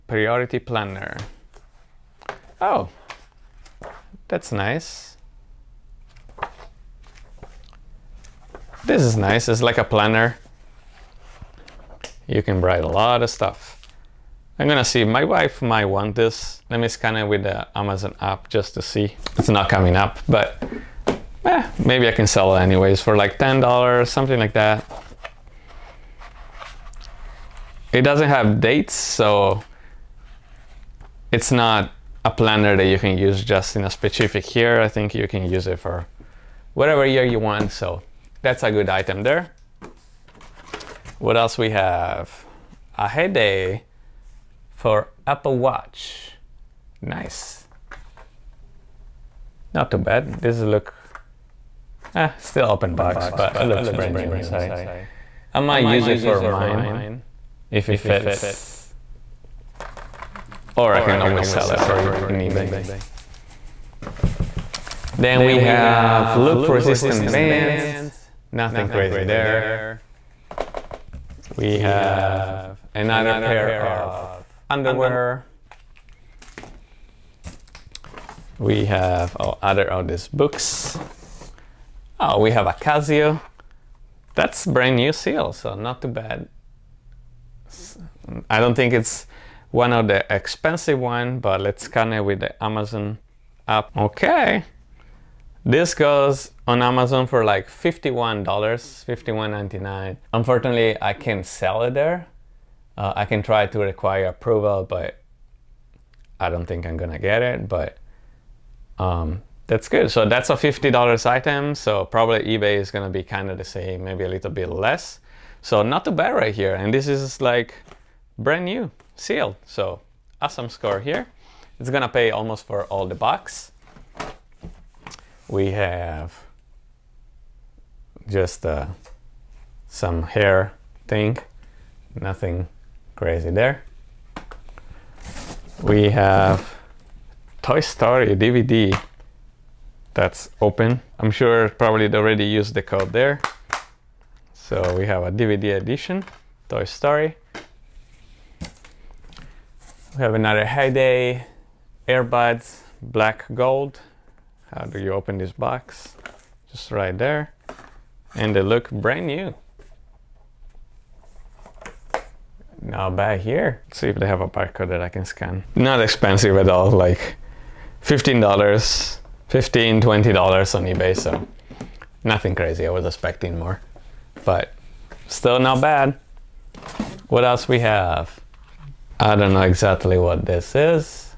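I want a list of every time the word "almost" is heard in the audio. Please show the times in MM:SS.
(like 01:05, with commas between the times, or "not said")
02:02.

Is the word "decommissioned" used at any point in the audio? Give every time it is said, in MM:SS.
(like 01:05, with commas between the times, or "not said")
not said.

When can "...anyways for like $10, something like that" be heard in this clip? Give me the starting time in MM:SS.
00:22.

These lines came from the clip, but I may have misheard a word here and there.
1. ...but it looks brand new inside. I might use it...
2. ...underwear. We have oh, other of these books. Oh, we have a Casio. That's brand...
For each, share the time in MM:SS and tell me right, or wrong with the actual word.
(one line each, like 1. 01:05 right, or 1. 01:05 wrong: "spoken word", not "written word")
1. 00:53 right
2. 01:14 right.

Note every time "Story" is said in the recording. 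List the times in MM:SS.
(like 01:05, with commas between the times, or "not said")
02:17, 02:26.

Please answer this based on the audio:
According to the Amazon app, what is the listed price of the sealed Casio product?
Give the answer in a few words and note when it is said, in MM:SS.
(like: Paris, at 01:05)
$51.99, at 01:38.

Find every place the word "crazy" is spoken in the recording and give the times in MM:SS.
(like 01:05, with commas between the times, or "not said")
01:08, 02:13, 02:52.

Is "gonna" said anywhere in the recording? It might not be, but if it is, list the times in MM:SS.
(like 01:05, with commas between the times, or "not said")
00:14, 01:46, 01:52, 02:01.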